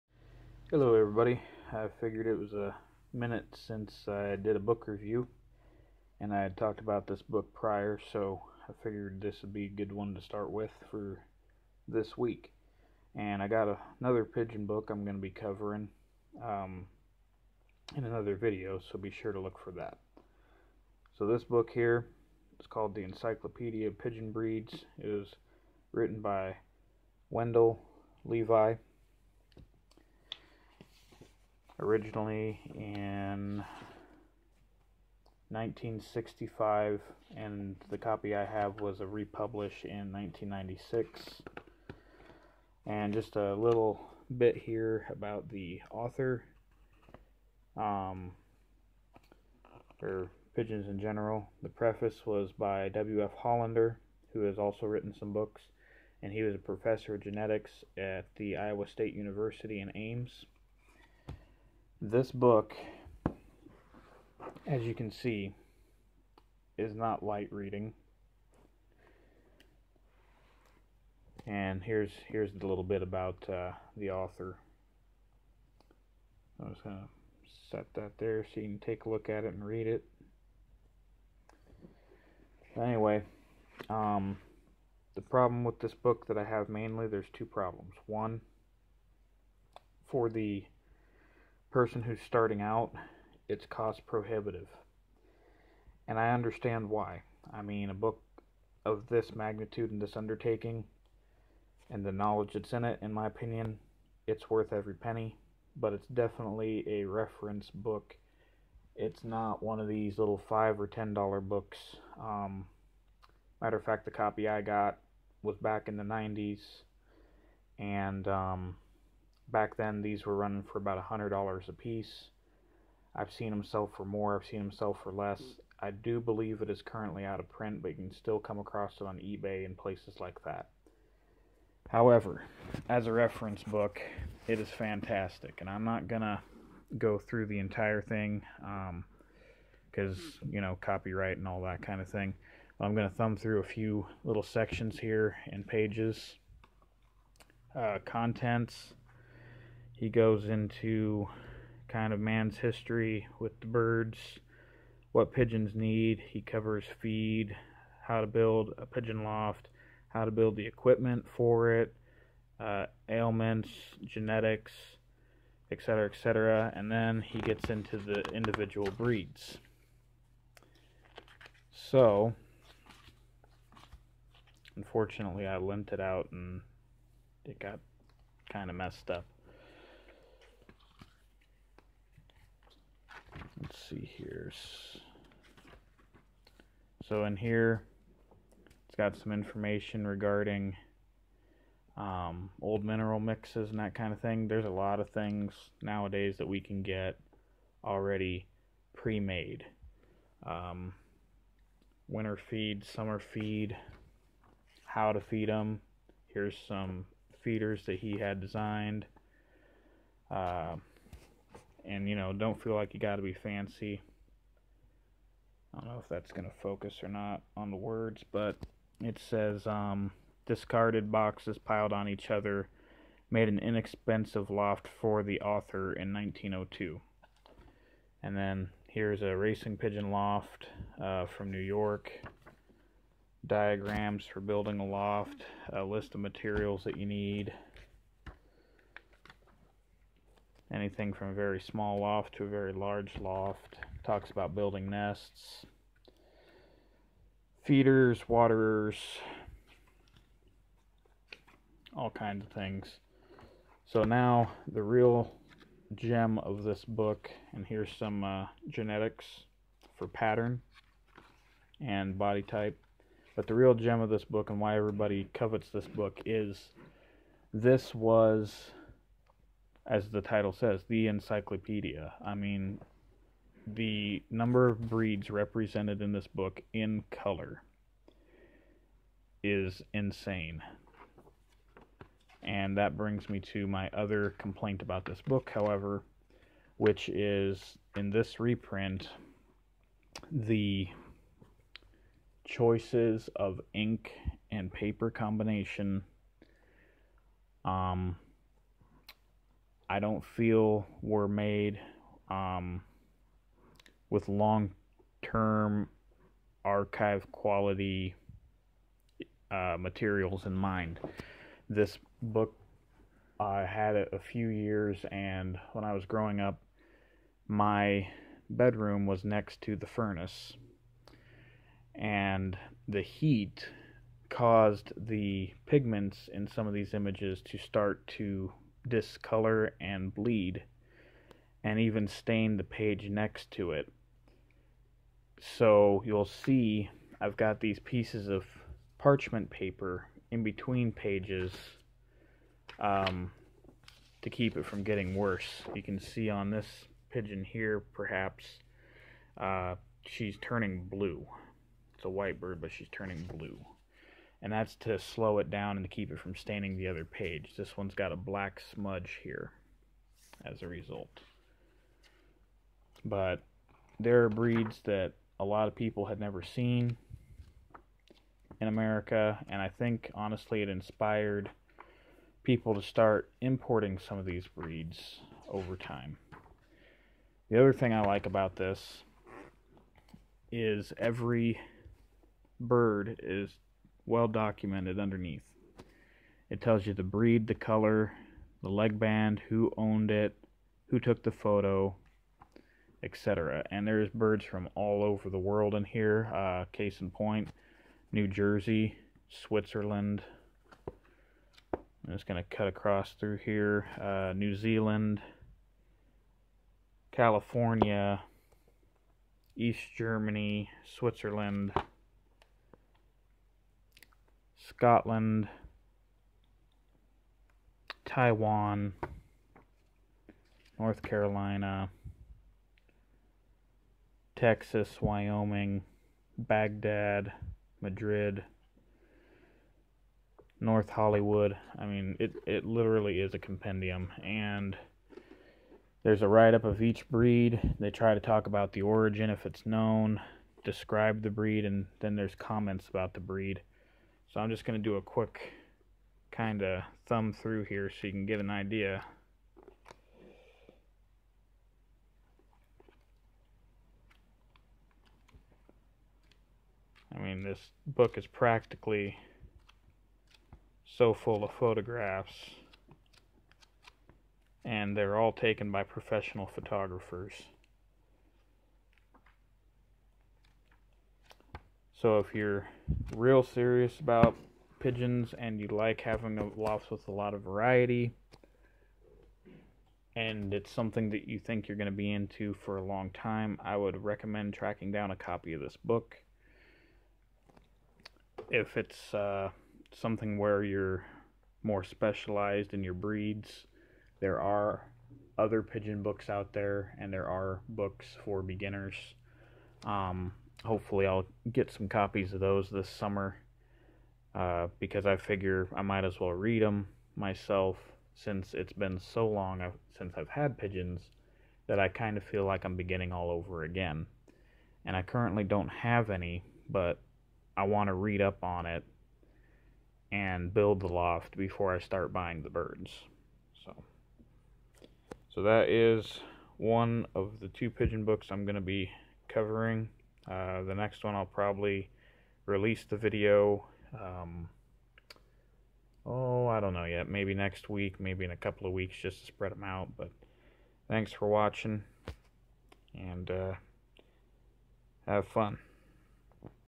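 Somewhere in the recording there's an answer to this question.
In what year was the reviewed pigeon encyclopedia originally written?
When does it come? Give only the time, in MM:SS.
00:35.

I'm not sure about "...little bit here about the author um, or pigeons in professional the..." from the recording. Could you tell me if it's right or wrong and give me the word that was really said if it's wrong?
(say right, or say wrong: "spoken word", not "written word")
wrong: "general", not "professional".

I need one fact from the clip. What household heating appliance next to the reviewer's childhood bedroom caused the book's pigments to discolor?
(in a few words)
furnace.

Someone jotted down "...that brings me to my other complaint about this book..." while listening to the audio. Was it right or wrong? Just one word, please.
right.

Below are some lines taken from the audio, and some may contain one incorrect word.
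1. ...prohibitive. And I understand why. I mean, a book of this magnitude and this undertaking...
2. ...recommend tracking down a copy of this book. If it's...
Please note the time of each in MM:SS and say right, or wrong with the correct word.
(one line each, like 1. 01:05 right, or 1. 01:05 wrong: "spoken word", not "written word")
1. 01:34 right
2. 08:04 right.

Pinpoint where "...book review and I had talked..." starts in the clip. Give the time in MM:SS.
00:04.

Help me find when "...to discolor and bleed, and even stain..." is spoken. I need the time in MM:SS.
05:28.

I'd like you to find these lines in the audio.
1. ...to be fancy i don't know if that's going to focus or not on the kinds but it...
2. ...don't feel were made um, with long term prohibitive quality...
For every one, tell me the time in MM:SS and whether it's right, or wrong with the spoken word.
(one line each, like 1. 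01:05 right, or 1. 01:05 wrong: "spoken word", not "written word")
1. 03:33 wrong: "words", not "kinds"
2. 04:59 wrong: "archive", not "prohibitive".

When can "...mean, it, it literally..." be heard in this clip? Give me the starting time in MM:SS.
07:11.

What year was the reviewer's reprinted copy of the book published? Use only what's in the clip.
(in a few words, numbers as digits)
1996.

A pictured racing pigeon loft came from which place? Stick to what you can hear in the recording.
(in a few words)
New York.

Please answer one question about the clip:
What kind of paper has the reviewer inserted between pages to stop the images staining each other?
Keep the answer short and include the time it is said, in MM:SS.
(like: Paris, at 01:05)
parchment paper, at 05:38.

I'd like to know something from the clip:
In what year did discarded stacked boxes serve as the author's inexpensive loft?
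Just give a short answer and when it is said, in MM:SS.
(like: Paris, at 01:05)
1902, at 03:46.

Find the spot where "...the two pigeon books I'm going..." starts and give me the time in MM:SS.
08:47.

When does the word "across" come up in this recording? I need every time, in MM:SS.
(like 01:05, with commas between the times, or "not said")
02:08, 06:42.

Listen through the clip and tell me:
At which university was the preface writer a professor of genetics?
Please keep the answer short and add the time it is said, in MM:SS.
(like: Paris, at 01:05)
Iowa State University, at 00:58.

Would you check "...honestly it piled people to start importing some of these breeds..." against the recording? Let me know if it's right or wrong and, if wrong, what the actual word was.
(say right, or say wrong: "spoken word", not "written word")
wrong: "inspired", not "piled".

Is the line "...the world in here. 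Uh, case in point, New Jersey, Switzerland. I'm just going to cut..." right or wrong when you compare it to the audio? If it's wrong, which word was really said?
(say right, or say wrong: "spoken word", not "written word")
right.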